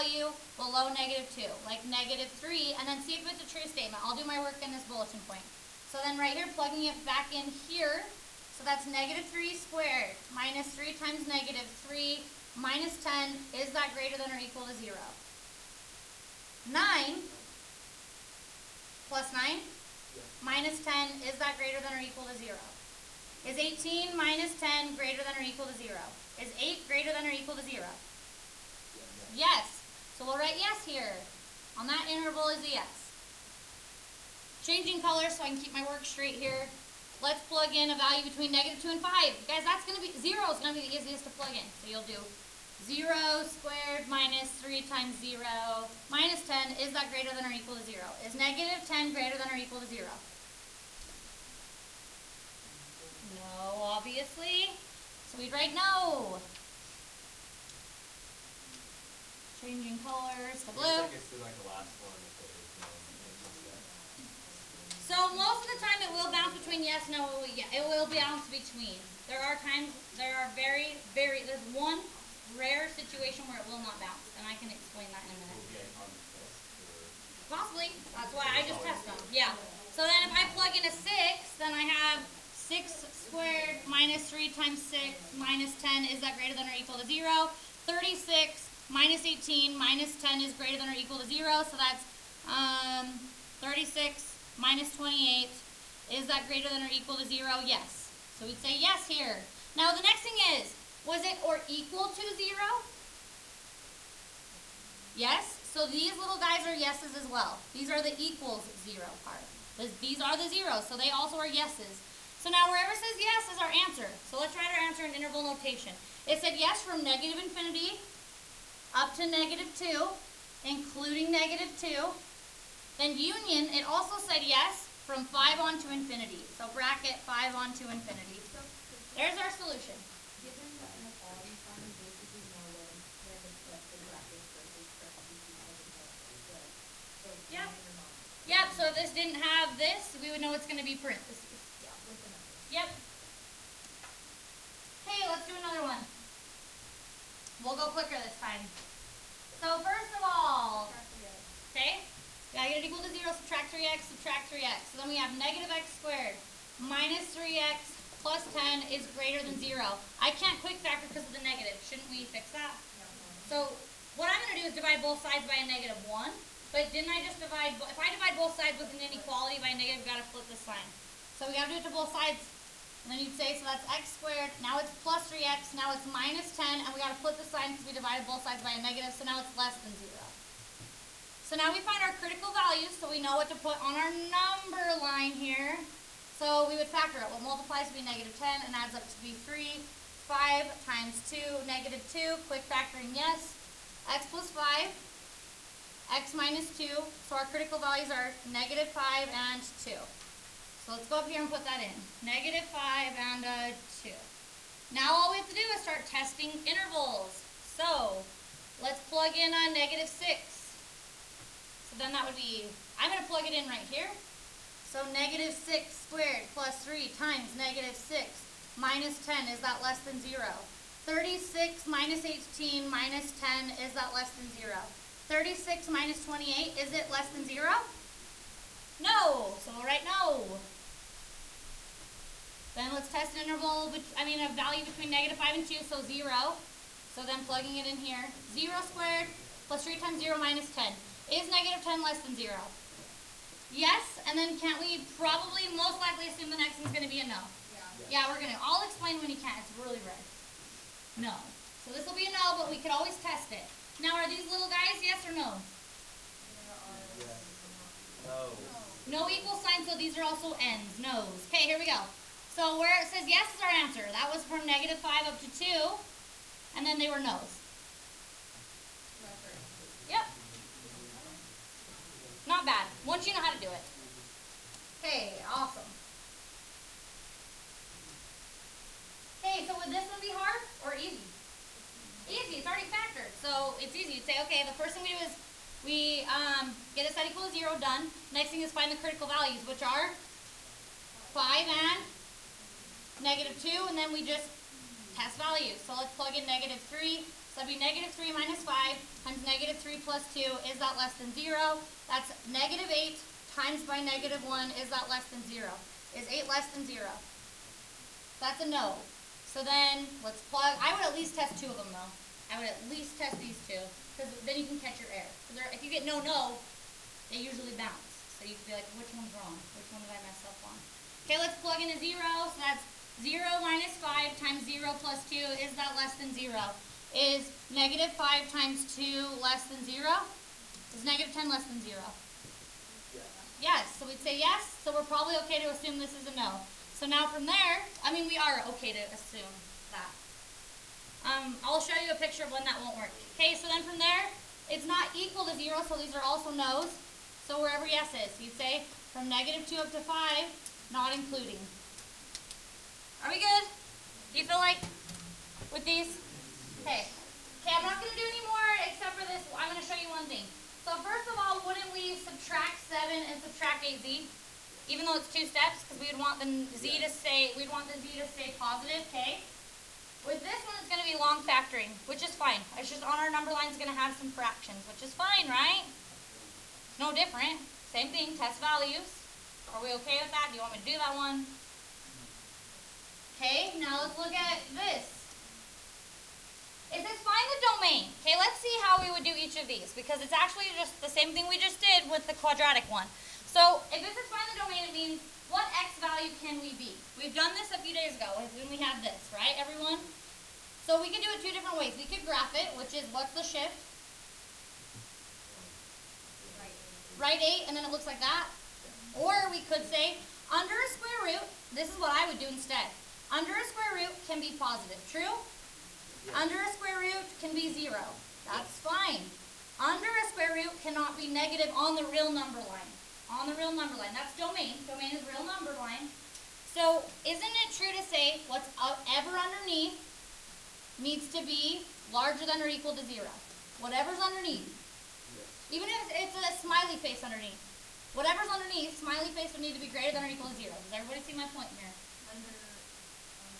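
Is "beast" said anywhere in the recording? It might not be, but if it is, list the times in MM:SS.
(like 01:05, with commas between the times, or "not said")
not said.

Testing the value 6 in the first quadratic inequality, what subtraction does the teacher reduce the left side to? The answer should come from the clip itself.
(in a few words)
36 minus 28.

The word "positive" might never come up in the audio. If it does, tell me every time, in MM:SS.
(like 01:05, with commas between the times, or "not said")
06:08, 06:54.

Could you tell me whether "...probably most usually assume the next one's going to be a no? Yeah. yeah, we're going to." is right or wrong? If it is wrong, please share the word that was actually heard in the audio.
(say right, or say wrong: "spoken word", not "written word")
wrong: "likely", not "usually".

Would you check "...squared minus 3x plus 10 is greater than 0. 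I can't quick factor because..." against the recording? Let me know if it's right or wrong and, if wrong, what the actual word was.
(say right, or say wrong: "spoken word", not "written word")
right.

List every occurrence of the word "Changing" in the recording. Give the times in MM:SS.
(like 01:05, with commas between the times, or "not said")
00:34, 00:59.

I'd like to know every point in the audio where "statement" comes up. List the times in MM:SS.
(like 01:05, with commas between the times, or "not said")
00:03.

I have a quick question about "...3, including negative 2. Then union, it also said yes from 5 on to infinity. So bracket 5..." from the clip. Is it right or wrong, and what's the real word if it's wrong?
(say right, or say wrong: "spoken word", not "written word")
wrong: "2", not "3".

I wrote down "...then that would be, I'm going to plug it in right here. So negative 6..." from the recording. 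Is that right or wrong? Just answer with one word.
right.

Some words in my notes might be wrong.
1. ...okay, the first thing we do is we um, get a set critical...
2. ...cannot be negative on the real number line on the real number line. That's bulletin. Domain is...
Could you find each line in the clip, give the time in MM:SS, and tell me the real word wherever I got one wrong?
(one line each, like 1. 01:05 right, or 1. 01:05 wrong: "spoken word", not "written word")
1. 04:44 wrong: "equal", not "critical"
2. 07:00 wrong: "domain", not "bulletin".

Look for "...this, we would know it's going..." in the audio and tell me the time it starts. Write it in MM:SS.
02:19.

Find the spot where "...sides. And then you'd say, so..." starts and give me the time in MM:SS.
02:52.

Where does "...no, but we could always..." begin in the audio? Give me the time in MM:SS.
04:12.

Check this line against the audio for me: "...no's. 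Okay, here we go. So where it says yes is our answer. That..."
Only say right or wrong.
right.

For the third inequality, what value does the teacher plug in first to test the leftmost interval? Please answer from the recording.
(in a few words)
-3.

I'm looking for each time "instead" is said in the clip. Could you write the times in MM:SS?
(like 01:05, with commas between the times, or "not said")
06:52.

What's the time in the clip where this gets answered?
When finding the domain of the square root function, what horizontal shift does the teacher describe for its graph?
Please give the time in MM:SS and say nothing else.
06:47.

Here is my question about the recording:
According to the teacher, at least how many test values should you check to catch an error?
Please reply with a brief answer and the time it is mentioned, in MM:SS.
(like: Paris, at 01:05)
2, at 05:10.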